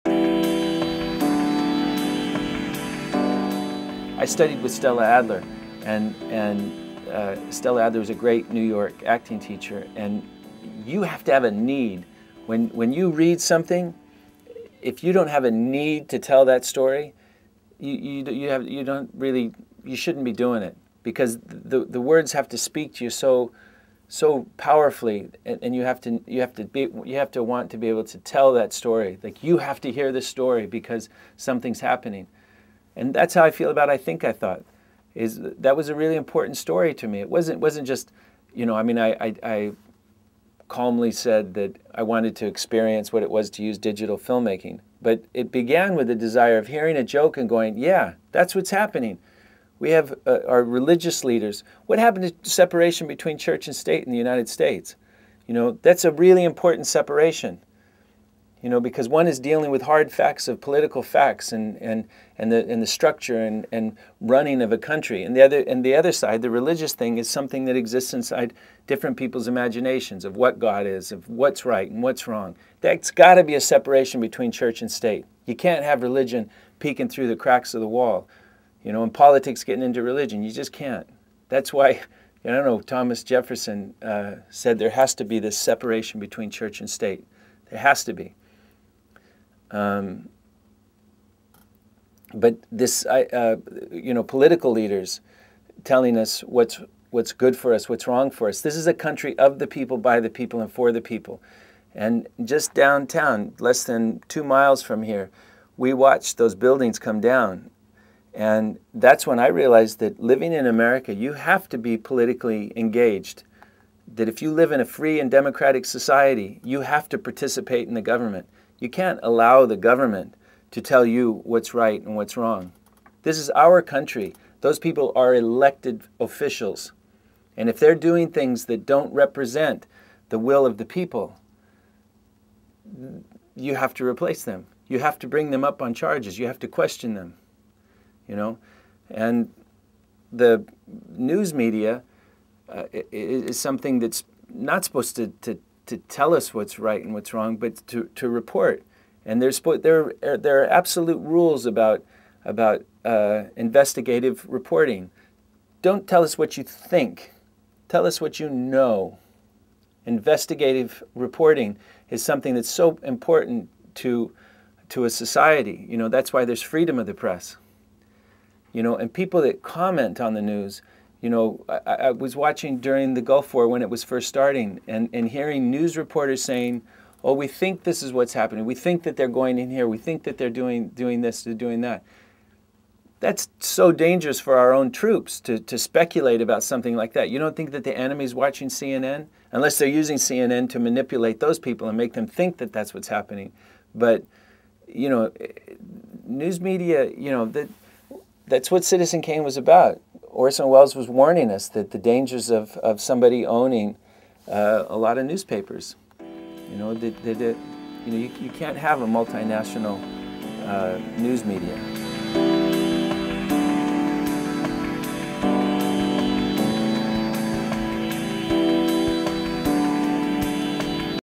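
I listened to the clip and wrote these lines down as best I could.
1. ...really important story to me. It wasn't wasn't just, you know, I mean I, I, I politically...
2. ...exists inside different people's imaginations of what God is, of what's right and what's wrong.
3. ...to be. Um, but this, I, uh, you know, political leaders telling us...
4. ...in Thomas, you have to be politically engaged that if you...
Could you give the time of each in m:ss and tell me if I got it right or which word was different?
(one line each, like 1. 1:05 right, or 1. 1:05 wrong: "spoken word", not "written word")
1. 0:35 wrong: "calmly", not "politically"
2. 1:07 right
3. 1:28 right
4. 1:50 wrong: "America", not "Thomas".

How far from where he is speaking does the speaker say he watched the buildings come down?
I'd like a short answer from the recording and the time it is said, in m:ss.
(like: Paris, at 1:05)
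less than 2 miles, at 1:43.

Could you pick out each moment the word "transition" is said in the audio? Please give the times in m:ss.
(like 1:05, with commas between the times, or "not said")
not said.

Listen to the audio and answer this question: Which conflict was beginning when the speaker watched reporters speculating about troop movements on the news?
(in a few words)
Gulf War.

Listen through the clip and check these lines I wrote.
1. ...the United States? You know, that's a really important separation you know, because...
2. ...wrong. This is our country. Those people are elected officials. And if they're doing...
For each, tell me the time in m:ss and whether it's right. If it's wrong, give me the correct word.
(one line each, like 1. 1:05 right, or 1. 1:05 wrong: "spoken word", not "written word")
1. 0:54 right
2. 2:02 right.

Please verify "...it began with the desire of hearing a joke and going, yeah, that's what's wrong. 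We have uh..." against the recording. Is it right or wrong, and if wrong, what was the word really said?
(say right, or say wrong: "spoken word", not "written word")
wrong: "happening", not "wrong".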